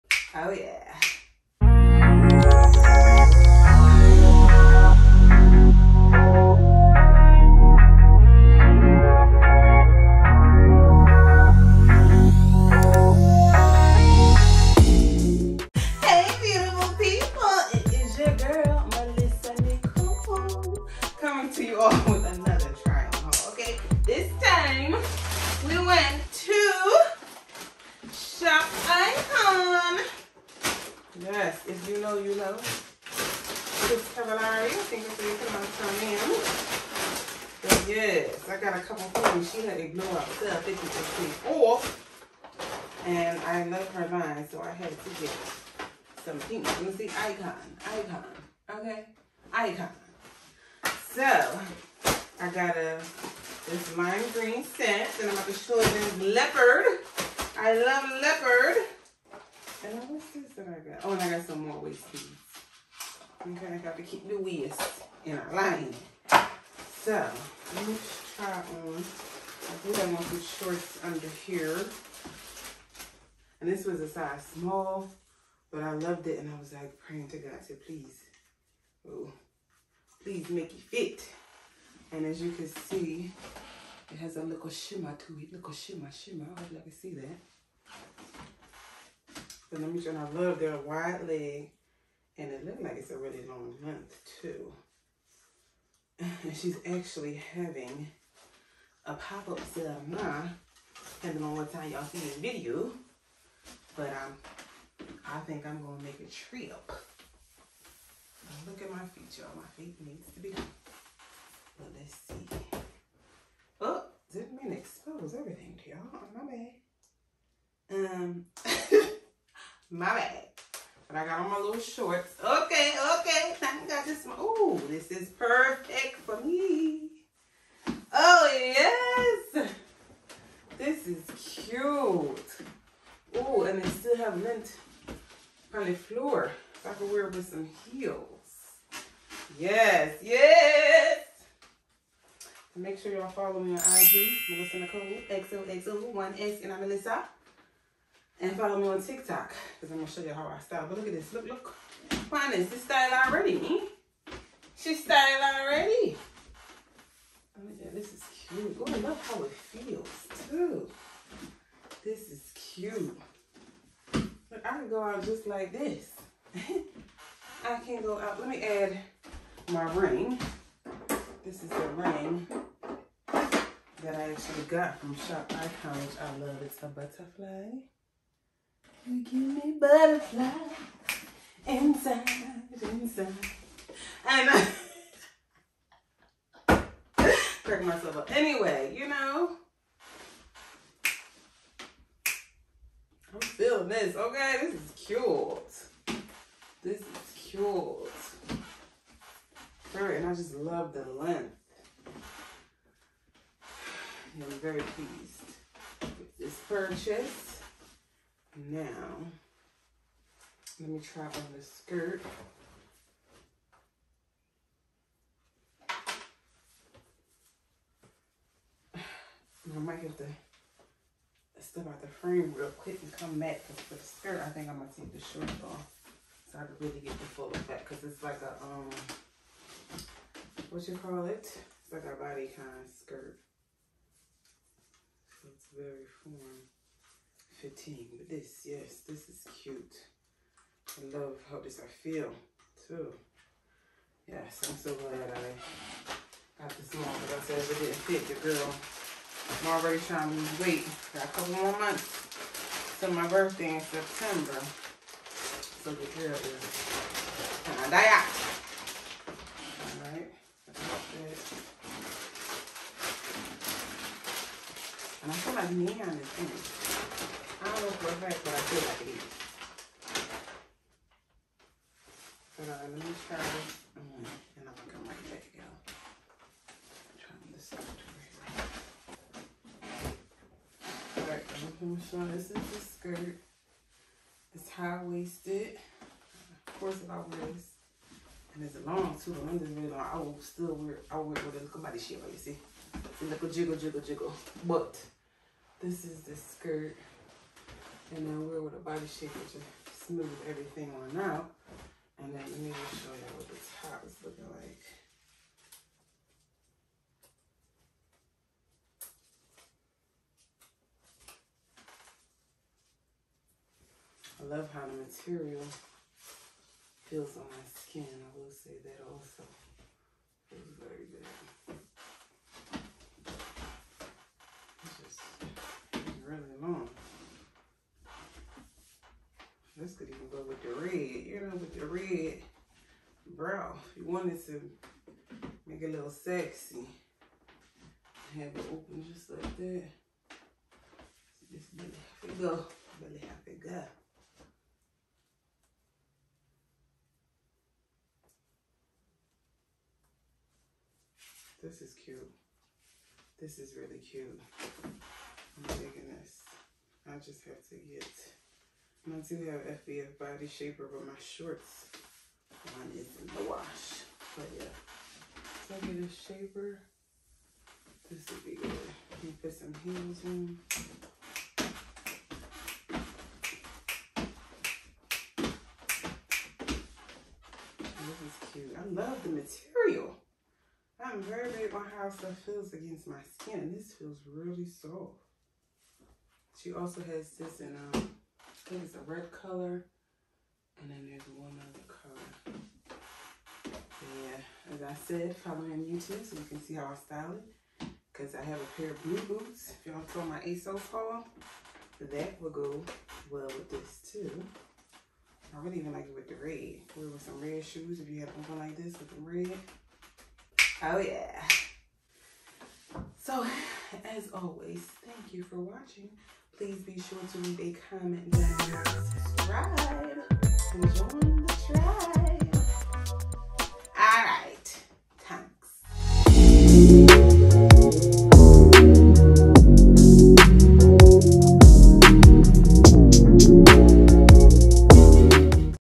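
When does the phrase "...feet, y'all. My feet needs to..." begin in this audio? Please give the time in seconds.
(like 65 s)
109 s.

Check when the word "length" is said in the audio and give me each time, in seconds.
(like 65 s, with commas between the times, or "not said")
93 s, 201 s, 289 s.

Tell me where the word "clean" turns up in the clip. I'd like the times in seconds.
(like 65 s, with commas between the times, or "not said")
41 s.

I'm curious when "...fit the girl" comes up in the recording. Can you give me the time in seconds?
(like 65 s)
248 s.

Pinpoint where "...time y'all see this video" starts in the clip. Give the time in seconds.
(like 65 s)
101 s.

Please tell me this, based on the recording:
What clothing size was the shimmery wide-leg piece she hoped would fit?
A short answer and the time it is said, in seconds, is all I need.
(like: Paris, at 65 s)
Small, at 74 s.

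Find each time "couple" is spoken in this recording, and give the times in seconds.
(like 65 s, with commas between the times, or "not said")
38 s, 251 s.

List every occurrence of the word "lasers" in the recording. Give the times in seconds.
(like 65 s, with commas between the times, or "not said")
not said.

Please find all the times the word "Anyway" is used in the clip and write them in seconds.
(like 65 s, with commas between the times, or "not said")
188 s.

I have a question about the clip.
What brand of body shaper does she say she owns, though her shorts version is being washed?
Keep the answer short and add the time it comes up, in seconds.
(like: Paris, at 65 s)
FBF, at 359 s.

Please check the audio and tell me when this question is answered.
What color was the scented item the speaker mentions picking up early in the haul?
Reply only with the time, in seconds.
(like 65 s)
53 s.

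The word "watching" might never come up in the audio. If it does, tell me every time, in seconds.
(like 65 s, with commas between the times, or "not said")
415 s.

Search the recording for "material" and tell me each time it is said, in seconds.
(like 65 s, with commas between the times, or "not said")
315 s, 379 s.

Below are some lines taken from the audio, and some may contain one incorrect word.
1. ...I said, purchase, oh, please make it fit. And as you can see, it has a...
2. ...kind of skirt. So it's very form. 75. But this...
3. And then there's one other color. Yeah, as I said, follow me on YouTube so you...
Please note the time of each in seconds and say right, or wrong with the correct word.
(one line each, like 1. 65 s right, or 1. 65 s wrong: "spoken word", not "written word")
1. 77 s wrong: "please", not "purchase"
2. 232 s wrong: "15", not "75"
3. 390 s right.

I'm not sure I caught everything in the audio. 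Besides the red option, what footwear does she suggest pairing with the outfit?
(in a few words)
Red shoes.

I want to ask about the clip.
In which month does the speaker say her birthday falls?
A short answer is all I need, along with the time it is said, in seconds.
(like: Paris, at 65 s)
September, at 253 s.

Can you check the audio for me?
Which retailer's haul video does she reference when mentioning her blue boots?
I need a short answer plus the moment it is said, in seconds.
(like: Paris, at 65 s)
ASOS, at 400 s.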